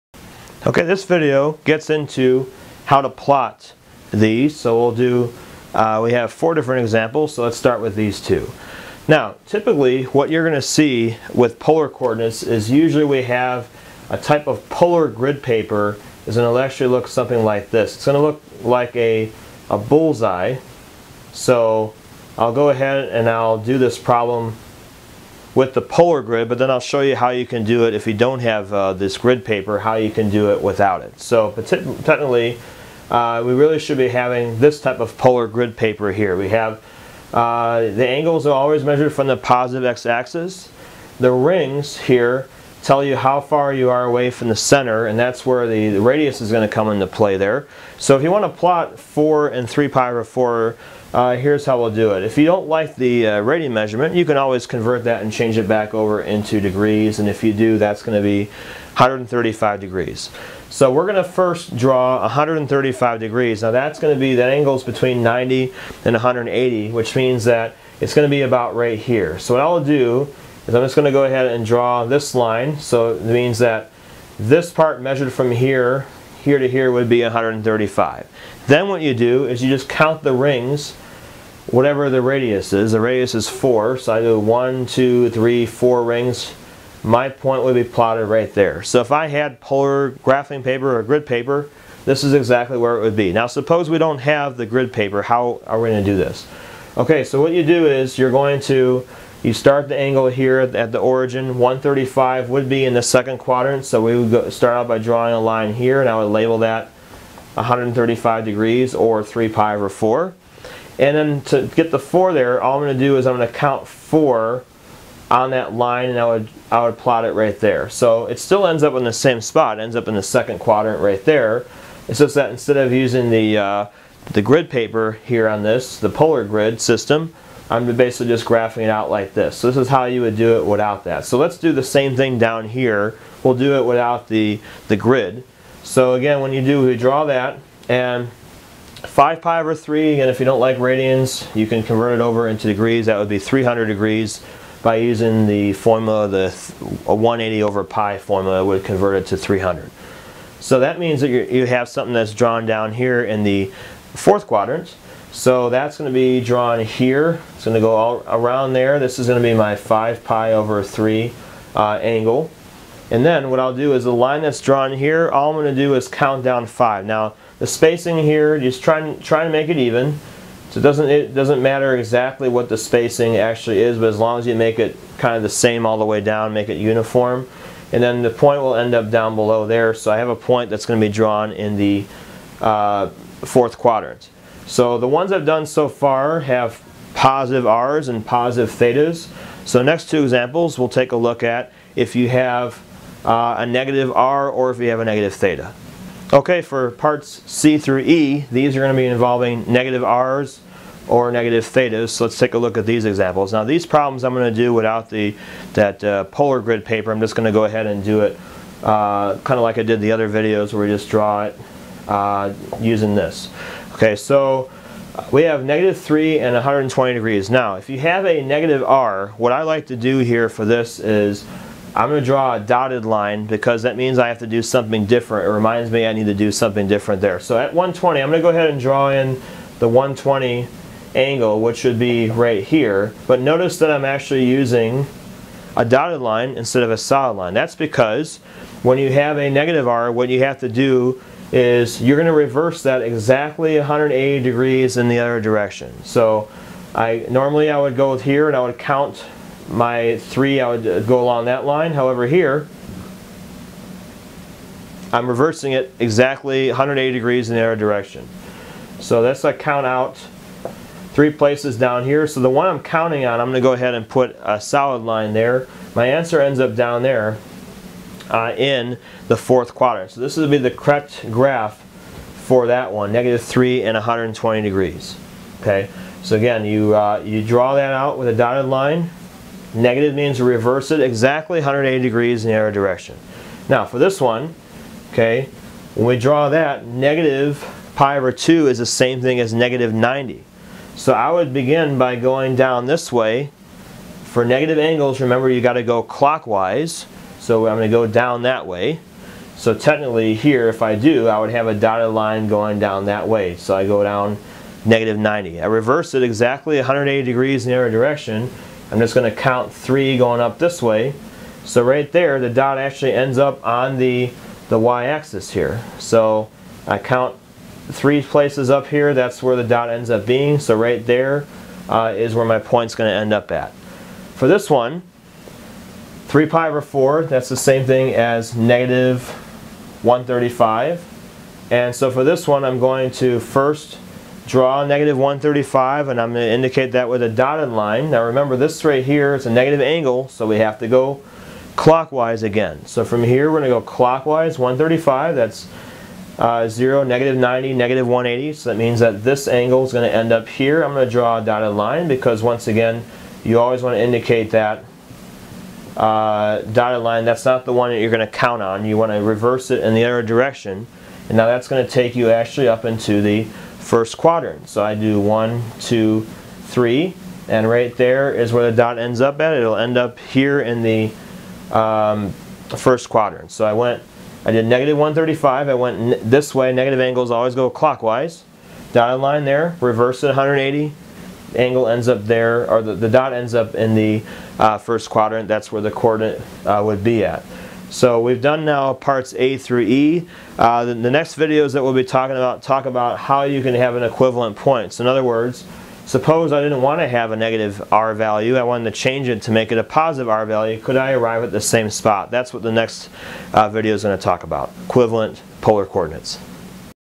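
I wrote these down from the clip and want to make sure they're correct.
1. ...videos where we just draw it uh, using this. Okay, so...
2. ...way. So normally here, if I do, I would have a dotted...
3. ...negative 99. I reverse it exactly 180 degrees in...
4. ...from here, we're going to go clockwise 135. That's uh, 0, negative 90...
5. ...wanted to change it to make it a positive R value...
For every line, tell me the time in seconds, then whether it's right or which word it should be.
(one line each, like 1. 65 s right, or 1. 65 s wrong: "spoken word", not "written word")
1. 210 s right
2. 298 s wrong: "technically", not "normally"
3. 304 s wrong: "90", not "99"
4. 343 s right
5. 398 s right.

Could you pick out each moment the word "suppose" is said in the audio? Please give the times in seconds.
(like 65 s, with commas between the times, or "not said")
93 s, 396 s.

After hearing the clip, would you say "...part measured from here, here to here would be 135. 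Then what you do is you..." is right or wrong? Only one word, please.
right.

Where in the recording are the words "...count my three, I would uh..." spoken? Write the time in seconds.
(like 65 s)
248 s.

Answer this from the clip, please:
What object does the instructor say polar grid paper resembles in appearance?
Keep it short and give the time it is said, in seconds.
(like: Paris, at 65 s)
a bullseye, at 19 s.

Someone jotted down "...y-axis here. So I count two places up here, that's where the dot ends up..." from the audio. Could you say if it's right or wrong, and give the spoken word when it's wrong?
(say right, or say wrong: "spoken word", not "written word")
wrong: "three", not "two".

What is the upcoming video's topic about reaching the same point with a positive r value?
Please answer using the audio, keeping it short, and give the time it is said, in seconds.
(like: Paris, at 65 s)
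equivalent polar coordinates, at 404 s.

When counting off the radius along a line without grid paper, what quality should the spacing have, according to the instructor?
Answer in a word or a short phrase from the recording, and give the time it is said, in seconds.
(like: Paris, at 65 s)
uniform, at 176 s.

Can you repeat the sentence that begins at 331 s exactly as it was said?
And so for this one, I'm going to first draw negative 135, and I'm going to indicate that with a dotted line.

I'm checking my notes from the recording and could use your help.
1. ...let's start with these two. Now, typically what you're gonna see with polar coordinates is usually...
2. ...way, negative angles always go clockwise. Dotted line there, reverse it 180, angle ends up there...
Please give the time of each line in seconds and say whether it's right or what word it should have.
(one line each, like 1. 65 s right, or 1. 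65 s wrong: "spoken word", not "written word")
1. 7 s right
2. 376 s right.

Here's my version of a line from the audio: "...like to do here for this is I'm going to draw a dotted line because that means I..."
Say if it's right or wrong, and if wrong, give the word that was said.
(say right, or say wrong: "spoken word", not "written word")
right.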